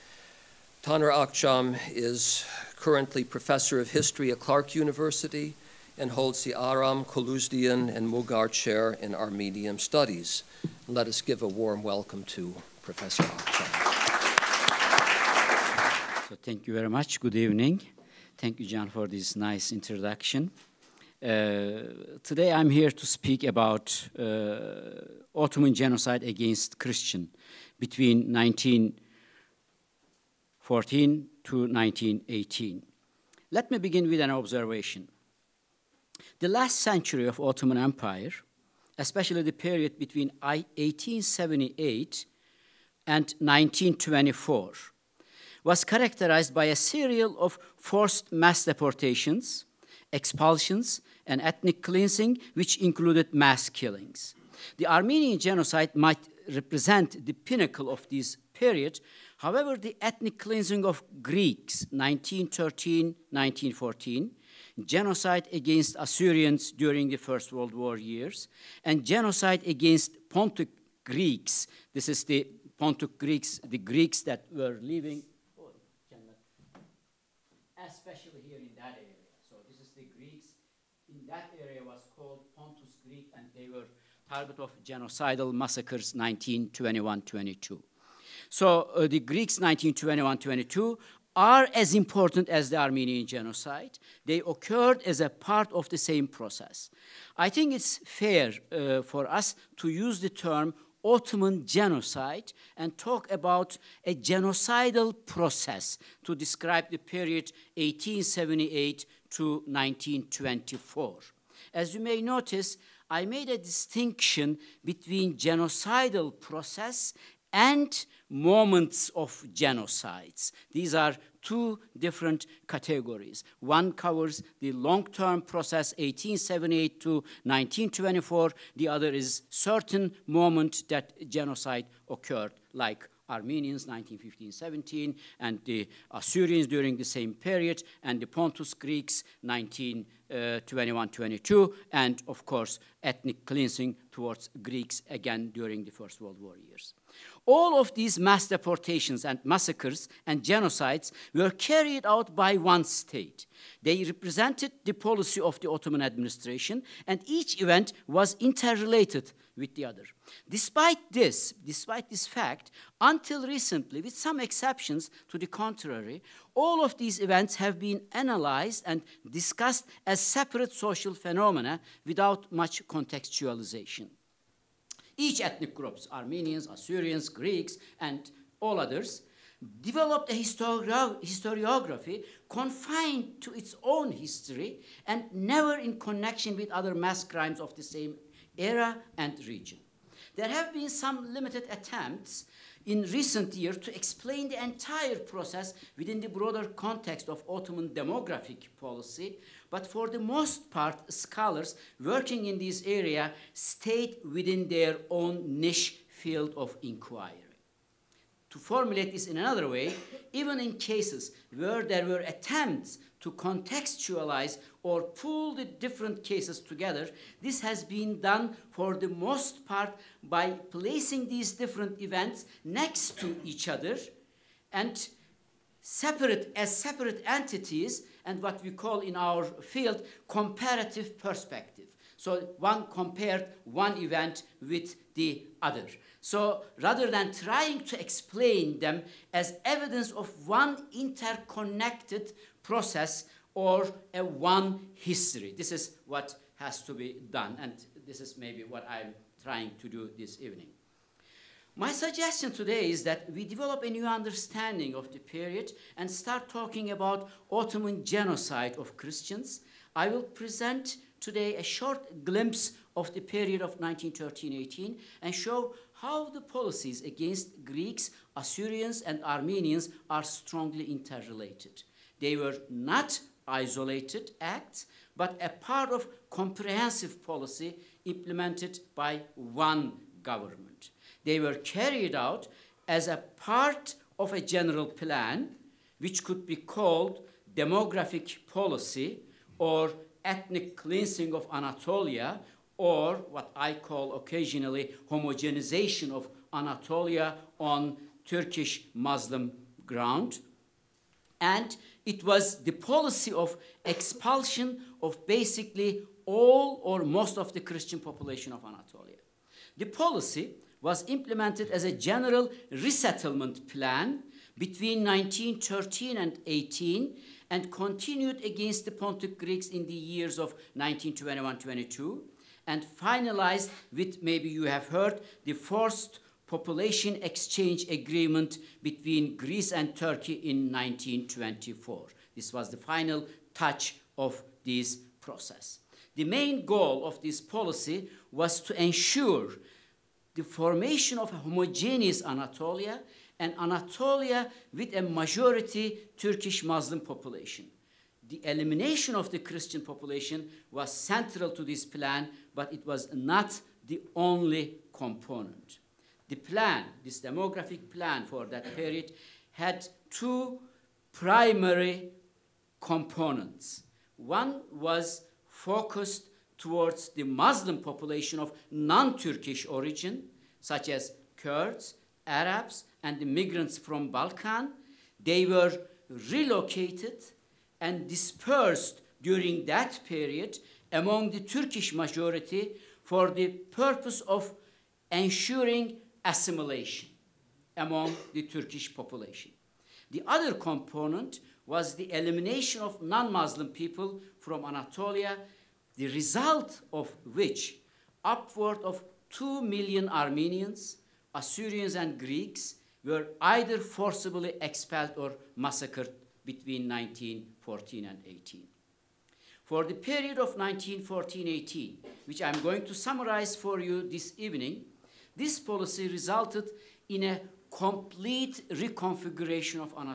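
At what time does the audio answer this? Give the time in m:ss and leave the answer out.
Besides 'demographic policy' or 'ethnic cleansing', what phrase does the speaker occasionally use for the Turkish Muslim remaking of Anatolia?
4:55.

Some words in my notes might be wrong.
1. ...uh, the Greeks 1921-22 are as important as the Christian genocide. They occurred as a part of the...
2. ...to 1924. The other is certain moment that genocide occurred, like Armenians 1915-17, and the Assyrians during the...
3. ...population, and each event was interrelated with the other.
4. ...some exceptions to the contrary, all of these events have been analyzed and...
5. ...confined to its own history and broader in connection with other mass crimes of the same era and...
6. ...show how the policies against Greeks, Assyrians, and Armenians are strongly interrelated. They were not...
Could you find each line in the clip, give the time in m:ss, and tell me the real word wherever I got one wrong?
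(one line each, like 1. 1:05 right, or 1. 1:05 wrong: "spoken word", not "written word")
1. 1:28 wrong: "Armenian", not "Christian"
2. 2:07 right
3. 2:36 wrong: "administration", not "population"
4. 2:44 right
5. 3:02 wrong: "never", not "broader"
6. 4:25 right.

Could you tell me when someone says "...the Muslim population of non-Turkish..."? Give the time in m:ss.
6:07.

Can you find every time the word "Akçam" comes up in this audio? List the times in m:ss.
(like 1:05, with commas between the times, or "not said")
0:01, 0:13.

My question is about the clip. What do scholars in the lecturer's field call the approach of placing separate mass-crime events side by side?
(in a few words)
comparative perspective.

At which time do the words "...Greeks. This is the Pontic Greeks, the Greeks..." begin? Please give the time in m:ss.
1:11.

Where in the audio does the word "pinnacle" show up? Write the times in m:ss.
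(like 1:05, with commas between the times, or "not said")
0:57.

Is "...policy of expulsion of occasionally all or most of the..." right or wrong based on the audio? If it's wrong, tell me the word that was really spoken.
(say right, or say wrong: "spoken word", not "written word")
wrong: "basically", not "occasionally".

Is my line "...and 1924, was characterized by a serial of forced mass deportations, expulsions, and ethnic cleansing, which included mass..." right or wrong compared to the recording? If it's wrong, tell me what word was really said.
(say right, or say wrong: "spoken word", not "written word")
right.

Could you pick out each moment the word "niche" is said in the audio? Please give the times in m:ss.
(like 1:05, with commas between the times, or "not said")
3:25.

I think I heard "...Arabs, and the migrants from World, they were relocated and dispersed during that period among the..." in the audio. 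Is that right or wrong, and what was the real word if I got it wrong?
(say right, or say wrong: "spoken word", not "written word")
wrong: "Balkan", not "World".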